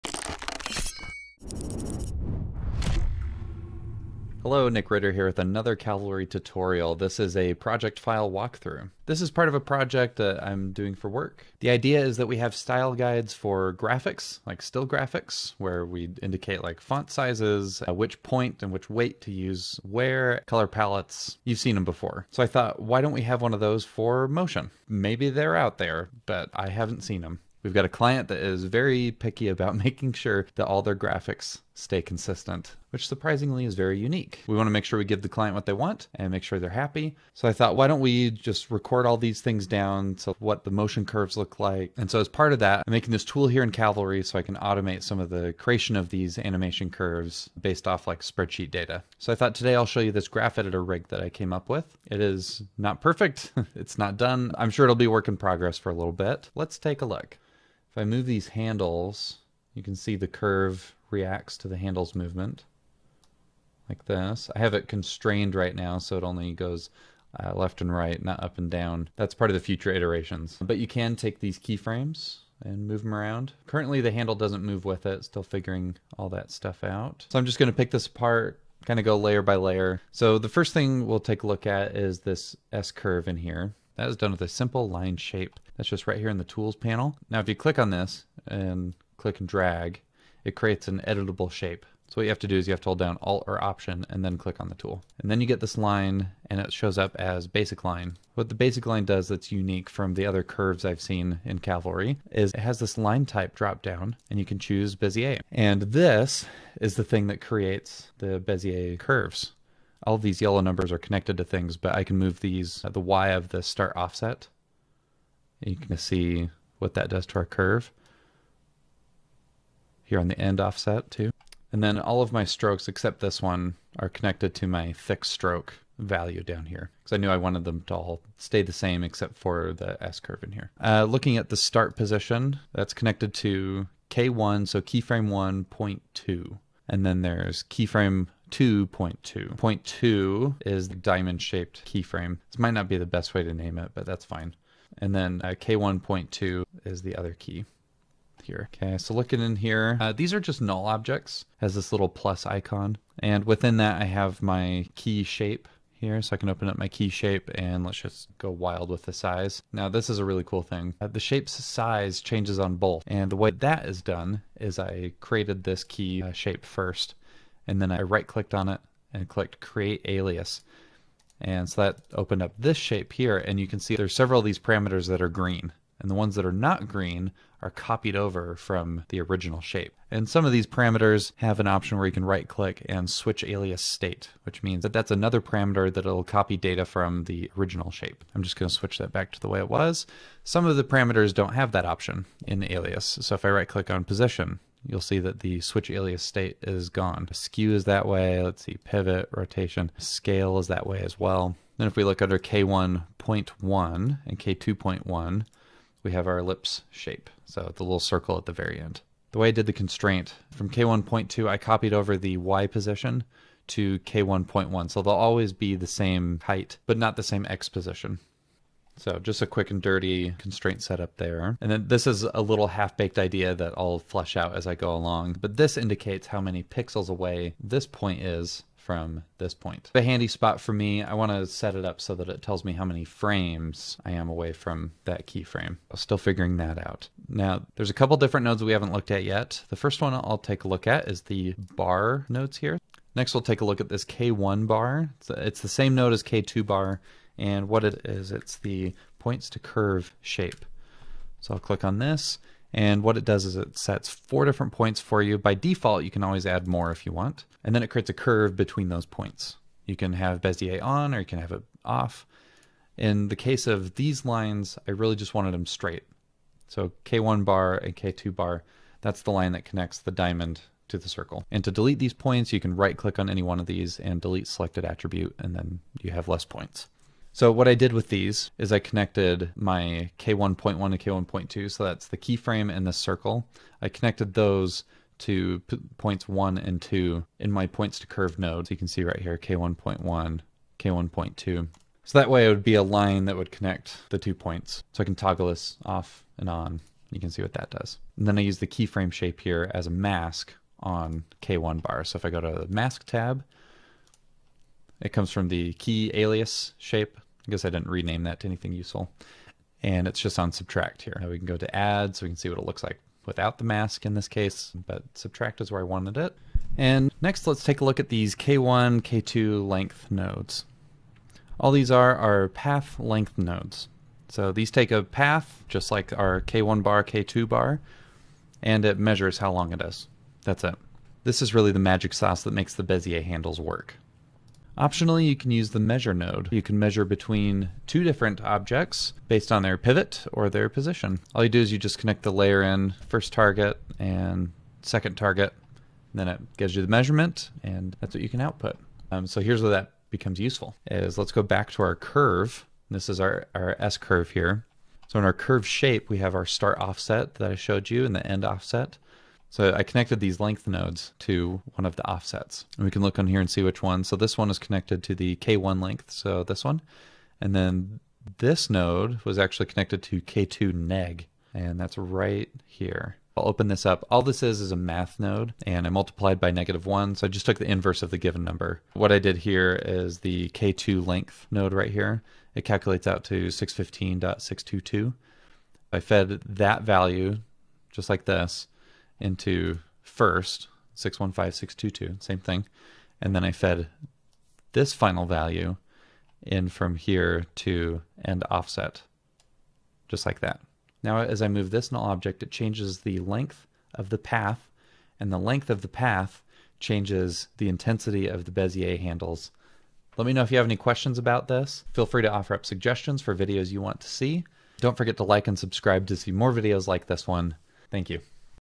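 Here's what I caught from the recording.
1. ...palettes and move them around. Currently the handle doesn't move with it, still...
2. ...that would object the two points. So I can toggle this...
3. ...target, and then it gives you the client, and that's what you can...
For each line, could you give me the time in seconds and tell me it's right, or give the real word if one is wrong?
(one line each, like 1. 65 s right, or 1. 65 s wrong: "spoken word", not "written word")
1. 71 s wrong: "keyframes", not "palettes"
2. 293 s wrong: "connect", not "object"
3. 345 s wrong: "measurement", not "client".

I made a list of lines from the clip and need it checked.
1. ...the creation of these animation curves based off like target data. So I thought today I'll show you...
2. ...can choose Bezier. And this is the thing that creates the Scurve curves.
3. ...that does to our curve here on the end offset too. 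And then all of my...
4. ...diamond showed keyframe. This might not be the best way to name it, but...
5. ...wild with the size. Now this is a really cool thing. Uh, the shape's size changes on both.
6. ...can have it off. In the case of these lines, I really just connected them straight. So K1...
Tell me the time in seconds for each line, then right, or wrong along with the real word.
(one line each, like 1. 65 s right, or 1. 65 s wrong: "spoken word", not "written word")
1. 45 s wrong: "spreadsheet", not "target"
2. 104 s wrong: "Bezier", not "Scurve"
3. 116 s right
4. 140 s wrong: "shaped", not "showed"
5. 158 s right
6. 261 s wrong: "wanted", not "connected".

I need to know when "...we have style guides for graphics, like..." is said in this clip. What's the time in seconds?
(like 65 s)
12 s.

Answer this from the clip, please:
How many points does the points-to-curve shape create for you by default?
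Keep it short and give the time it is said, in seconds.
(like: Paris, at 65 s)
4, at 254 s.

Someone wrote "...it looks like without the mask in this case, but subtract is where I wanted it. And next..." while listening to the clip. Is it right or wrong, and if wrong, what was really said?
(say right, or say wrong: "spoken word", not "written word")
right.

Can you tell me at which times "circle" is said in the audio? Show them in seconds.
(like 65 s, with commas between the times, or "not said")
207 s, 271 s, 282 s.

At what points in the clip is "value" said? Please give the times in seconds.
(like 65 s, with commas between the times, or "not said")
125 s, 386 s, 395 s.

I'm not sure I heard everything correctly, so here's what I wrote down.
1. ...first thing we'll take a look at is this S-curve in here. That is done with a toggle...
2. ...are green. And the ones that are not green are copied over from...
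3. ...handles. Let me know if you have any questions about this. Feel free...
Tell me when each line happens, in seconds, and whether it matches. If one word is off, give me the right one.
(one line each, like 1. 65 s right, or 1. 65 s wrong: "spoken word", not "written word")
1. 80 s wrong: "simple", not "toggle"
2. 175 s right
3. 408 s right.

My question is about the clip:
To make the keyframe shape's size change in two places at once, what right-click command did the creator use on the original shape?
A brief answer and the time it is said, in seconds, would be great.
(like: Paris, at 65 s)
create alias, at 169 s.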